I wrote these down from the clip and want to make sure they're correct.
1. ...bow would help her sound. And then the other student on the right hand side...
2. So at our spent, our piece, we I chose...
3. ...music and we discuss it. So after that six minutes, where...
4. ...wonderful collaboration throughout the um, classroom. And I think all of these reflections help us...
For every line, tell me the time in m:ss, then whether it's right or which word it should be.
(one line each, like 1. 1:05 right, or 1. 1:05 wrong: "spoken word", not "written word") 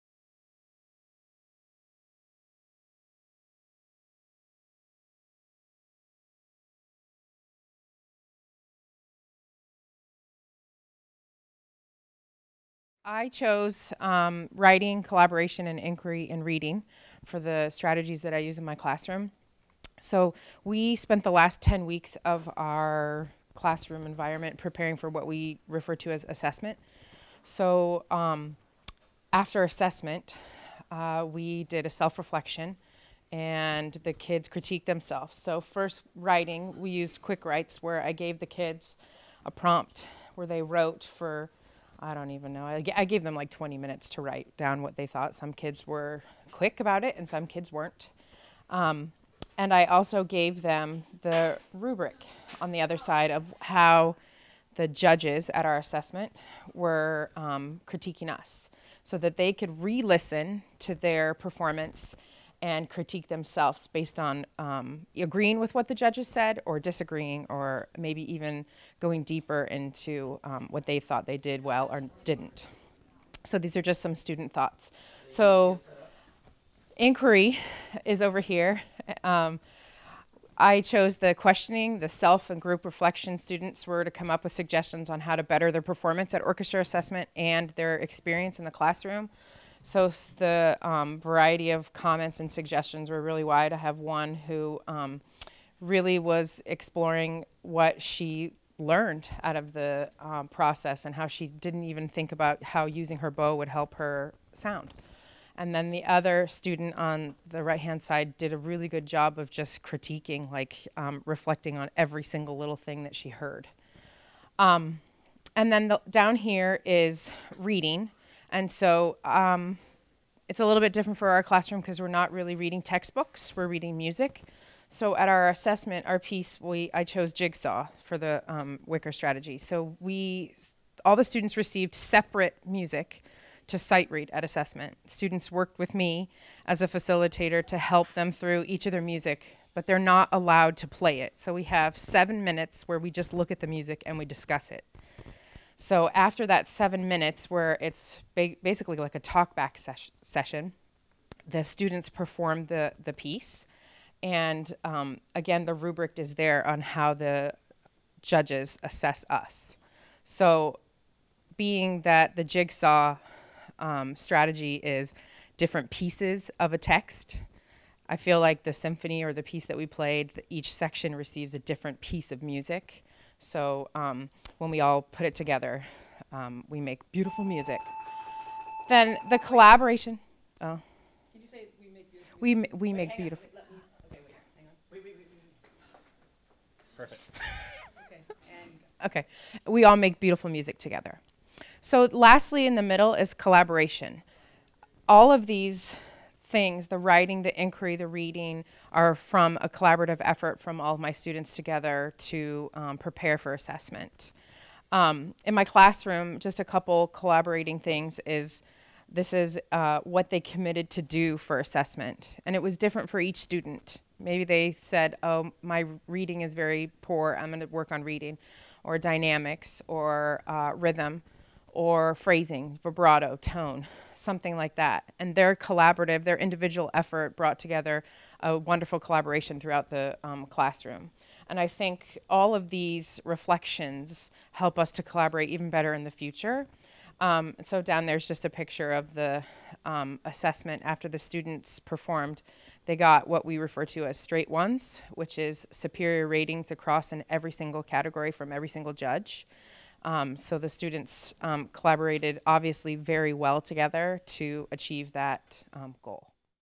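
1. 1:43 right
2. 2:04 wrong: "assessment", not "spent"
3. 2:23 wrong: "seven", not "six"
4. 3:48 right.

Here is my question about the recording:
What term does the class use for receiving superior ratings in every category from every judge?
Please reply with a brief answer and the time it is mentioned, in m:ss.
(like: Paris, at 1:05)
straight ones, at 4:04.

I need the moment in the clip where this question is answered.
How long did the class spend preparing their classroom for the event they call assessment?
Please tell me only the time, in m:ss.
0:21.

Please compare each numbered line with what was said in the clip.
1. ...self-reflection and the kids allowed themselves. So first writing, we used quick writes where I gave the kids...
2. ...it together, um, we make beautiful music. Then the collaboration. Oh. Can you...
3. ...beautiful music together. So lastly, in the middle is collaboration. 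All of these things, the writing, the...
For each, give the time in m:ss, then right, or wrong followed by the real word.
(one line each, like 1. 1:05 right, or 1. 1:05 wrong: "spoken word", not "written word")
1. 0:31 wrong: "critiqued", not "allowed"
2. 2:55 right
3. 3:10 right.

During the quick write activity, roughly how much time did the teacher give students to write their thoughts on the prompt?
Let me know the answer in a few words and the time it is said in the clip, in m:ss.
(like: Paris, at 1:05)
20 minutes, at 0:43.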